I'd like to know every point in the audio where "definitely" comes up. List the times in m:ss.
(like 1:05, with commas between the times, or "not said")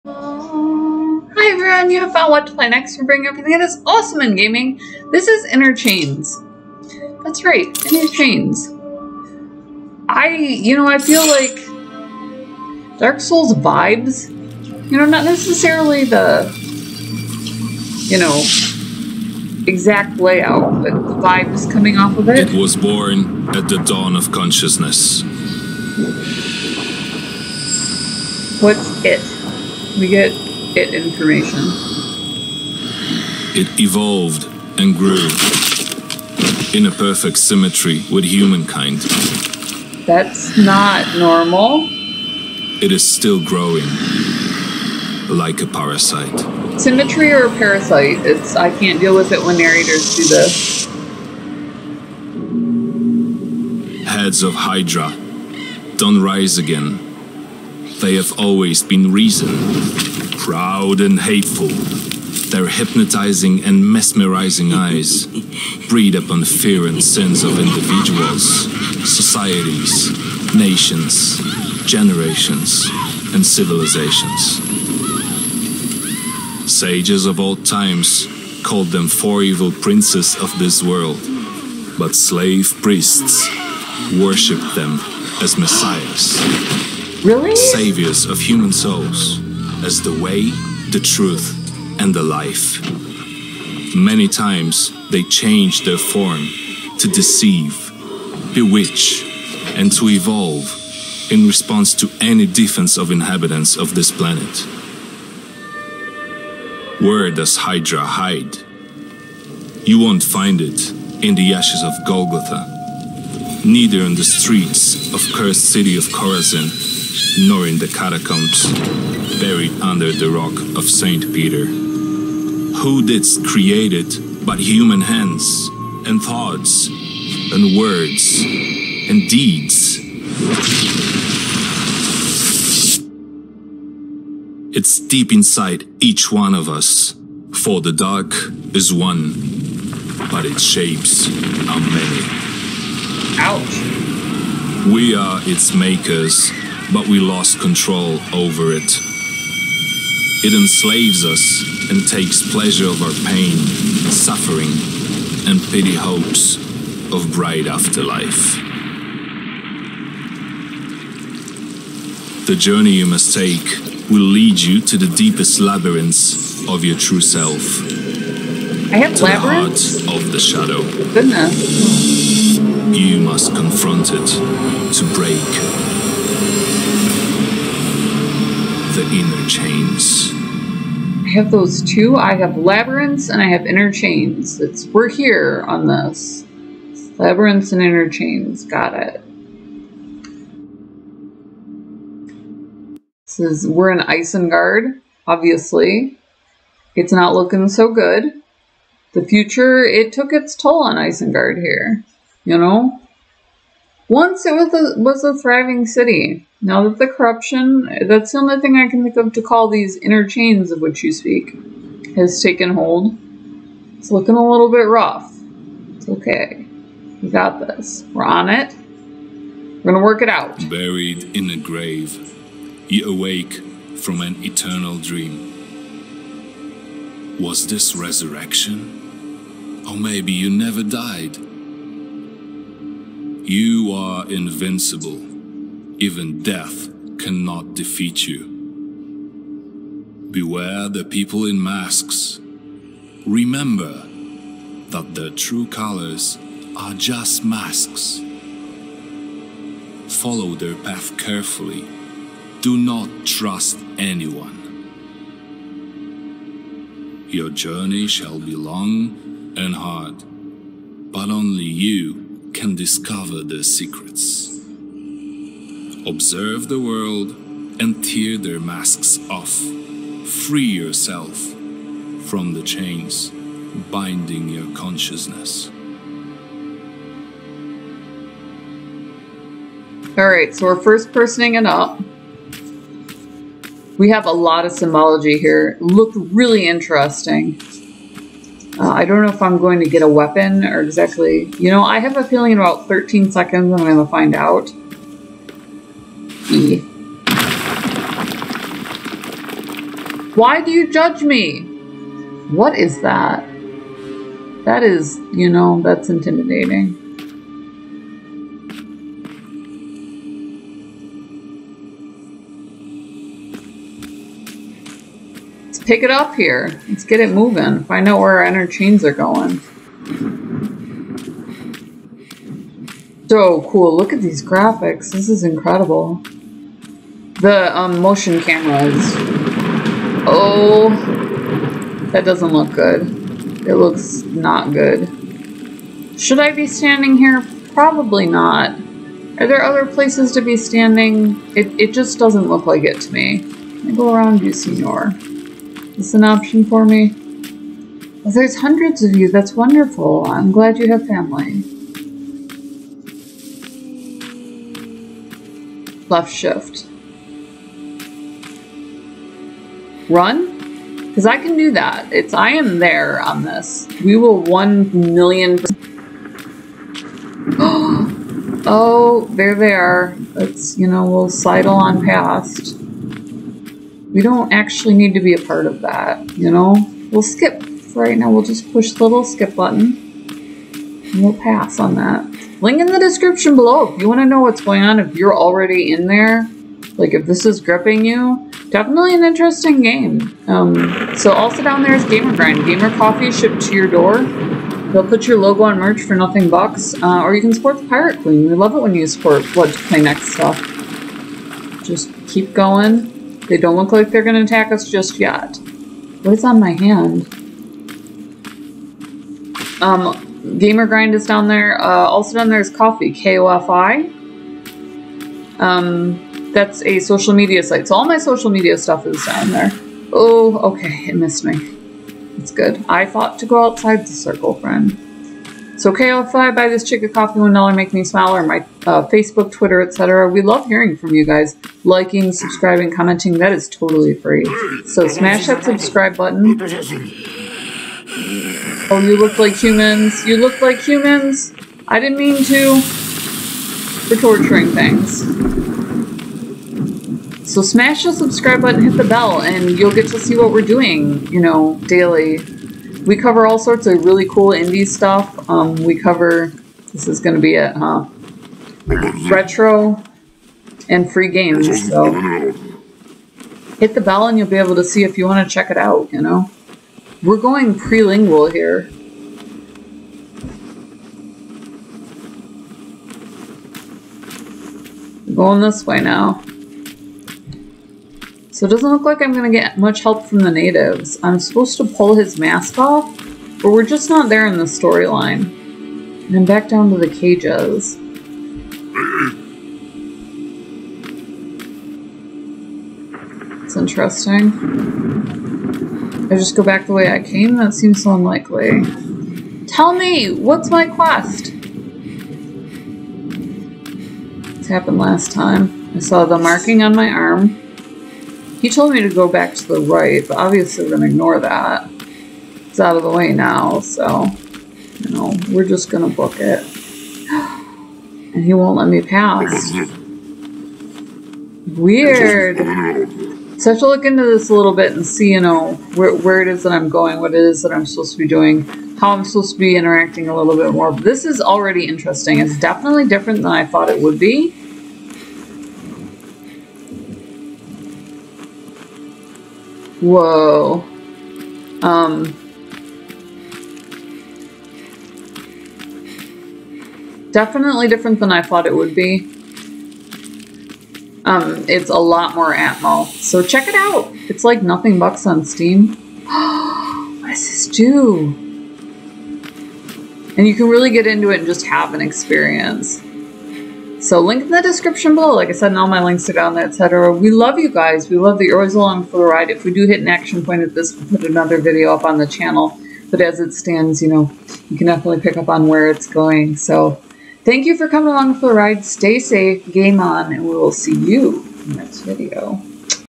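6:28, 8:52, 9:07, 9:34.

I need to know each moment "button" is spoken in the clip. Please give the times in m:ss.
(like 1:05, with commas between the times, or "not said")
6:19, 7:16, 7:28.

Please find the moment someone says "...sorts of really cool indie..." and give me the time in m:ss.
7:33.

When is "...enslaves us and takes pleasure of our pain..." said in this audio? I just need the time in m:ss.
2:30.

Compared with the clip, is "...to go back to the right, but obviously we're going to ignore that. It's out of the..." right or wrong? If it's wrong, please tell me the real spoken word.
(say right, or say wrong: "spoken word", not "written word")
right.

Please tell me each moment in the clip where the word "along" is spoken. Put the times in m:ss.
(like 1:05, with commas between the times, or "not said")
9:28, 9:38.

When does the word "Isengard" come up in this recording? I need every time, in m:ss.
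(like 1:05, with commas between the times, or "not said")
3:13, 3:20.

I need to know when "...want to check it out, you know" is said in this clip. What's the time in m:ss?
7:45.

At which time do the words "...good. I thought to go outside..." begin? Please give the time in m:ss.
7:02.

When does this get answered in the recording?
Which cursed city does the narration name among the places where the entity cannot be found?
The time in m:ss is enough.
1:56.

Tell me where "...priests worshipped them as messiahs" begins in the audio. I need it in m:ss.
1:22.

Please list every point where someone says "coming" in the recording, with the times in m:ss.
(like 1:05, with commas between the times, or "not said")
0:21, 9:37.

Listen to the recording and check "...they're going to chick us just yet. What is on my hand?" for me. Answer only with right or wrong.
wrong.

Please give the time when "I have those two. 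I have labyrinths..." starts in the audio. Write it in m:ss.
3:01.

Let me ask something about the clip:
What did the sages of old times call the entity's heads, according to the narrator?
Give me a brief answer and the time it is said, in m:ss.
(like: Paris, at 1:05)
four evil princes of this world, at 1:19.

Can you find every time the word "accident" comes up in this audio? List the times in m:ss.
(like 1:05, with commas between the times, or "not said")
not said.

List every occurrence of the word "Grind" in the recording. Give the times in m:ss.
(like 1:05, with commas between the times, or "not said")
6:32, 6:50.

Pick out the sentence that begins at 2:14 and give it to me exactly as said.
It's deep inside each one of us, for the dark is one, but its shapes are many.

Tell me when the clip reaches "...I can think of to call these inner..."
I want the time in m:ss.
3:28.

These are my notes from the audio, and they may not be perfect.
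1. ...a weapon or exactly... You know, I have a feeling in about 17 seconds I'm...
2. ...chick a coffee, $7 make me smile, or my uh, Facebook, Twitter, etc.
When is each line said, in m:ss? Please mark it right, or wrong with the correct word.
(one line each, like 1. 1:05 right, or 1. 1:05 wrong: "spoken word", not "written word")
1. 4:50 wrong: "13", not "17"
2. 7:06 wrong: "1", not "7".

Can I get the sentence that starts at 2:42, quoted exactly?
The journey you must take will lead you to the deepest labyrinths of your true self.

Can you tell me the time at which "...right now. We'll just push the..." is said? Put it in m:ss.
6:17.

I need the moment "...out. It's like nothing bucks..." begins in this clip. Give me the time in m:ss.
9:13.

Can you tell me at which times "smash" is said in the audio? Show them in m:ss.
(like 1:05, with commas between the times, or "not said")
7:15, 7:27.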